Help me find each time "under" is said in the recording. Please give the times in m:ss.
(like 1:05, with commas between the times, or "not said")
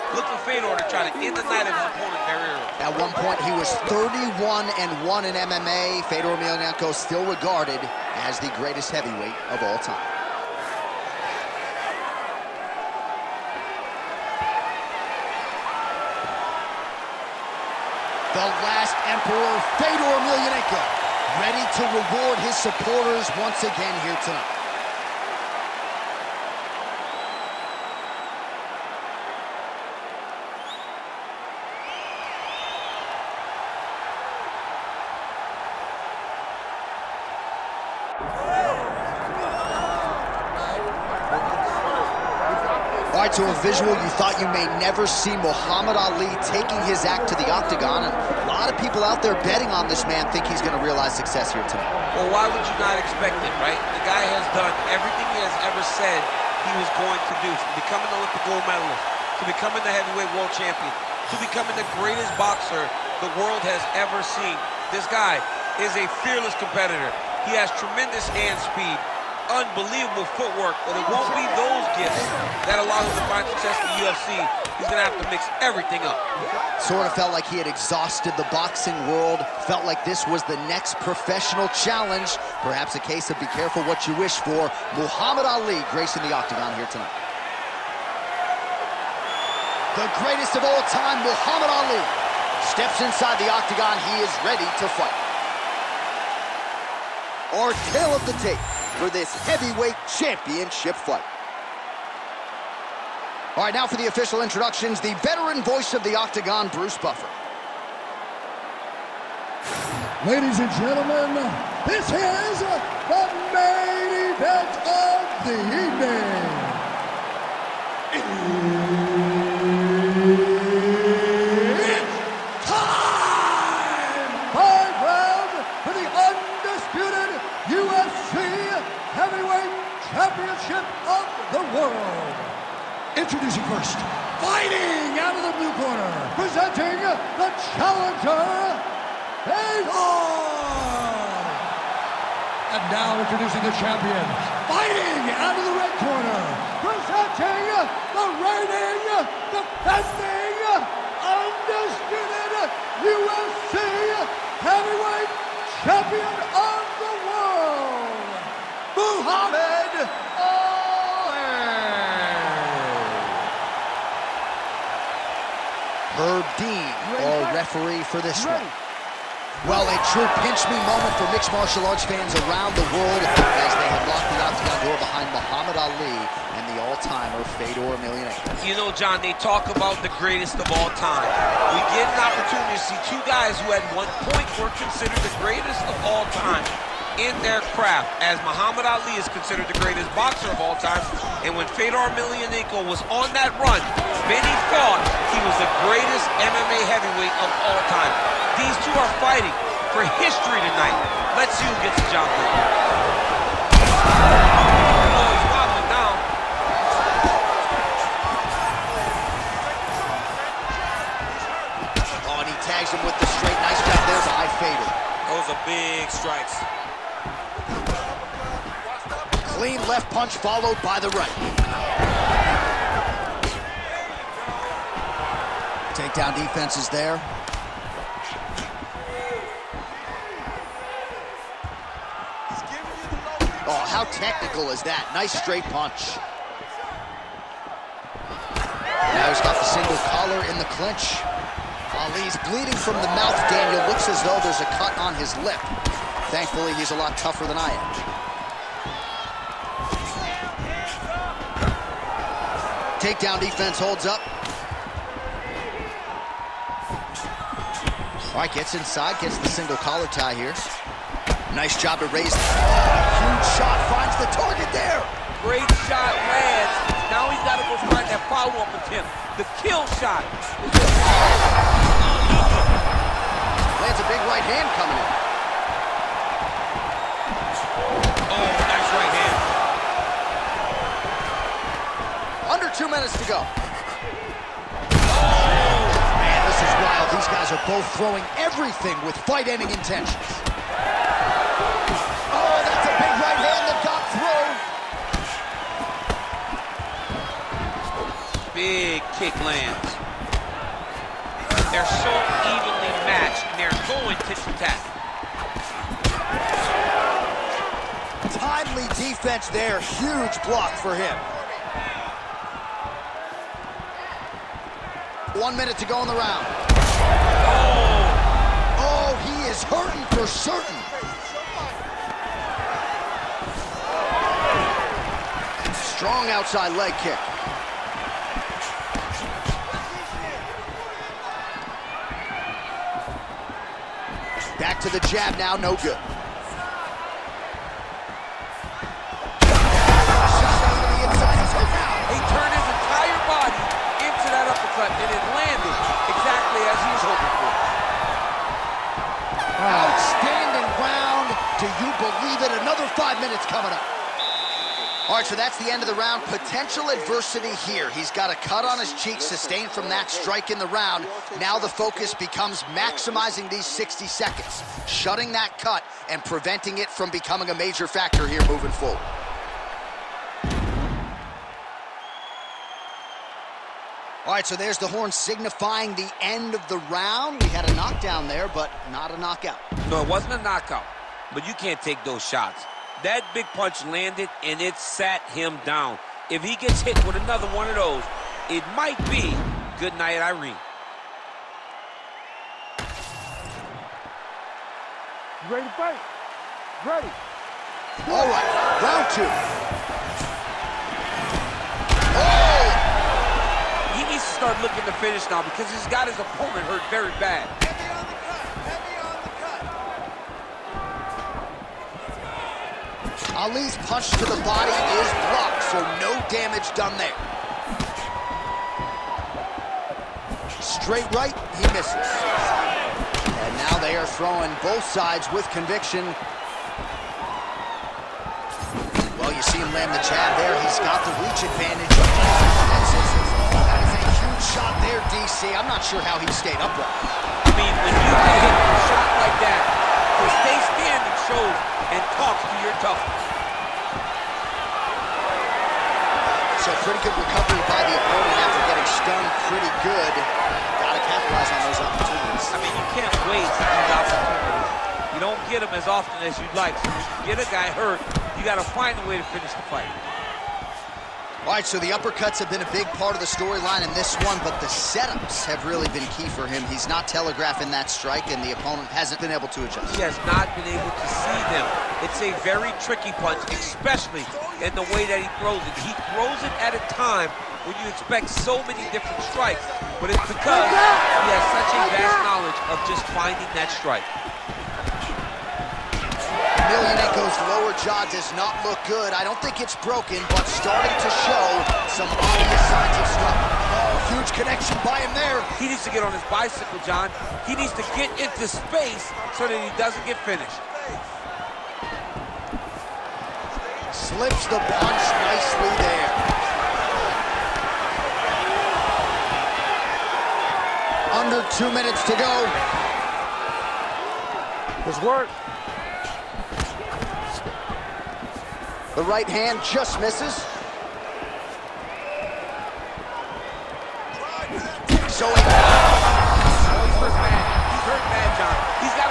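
4:42, 8:31.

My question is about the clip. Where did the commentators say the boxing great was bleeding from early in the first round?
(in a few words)
The mouth.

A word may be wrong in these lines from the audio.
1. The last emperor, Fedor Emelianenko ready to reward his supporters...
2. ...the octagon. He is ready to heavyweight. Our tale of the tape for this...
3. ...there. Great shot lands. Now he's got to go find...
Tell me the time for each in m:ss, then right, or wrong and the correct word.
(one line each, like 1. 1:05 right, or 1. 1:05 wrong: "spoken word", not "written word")
1. 0:18 right
2. 1:33 wrong: "fight", not "heavyweight"
3. 4:24 right.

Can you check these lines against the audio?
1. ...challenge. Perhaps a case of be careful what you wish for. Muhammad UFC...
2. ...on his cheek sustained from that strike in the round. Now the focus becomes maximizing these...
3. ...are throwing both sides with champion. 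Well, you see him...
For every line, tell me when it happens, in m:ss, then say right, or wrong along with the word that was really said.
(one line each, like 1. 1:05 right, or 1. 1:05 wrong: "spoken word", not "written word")
1. 1:21 wrong: "Ali", not "UFC"
2. 5:58 right
3. 7:03 wrong: "conviction", not "champion".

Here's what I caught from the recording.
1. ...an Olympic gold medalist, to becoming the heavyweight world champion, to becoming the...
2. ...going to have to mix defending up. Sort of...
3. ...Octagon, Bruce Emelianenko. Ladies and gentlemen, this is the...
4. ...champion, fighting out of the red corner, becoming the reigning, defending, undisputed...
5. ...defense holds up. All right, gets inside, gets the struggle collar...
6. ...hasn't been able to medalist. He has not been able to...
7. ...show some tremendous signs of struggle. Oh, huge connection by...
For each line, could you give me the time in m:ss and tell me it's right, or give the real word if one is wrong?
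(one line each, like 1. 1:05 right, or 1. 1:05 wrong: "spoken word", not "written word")
1. 0:58 right
2. 1:14 wrong: "everything", not "defending"
3. 1:46 wrong: "Buffer", not "Emelianenko"
4. 2:23 wrong: "presenting", not "becoming"
5. 4:13 wrong: "single", not "struggle"
6. 7:48 wrong: "adjust", not "medalist"
7. 8:11 wrong: "obvious", not "tremendous".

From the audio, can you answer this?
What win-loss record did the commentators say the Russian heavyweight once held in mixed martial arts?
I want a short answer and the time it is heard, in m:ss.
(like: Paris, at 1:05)
31 and 1, at 0:03.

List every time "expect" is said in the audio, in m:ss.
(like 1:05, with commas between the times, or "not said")
0:52, 7:57.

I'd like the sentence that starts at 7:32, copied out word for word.
I mean, you can't to these opportunities.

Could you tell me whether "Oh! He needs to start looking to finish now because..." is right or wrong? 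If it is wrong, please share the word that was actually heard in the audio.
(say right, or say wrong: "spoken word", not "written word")
right.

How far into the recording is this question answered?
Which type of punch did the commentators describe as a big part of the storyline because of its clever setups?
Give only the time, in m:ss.
7:41.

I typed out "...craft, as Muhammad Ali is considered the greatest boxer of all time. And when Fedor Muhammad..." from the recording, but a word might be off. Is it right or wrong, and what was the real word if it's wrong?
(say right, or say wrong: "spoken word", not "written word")
wrong: "Emelianenko", not "Muhammad".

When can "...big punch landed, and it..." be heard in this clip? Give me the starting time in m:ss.
6:23.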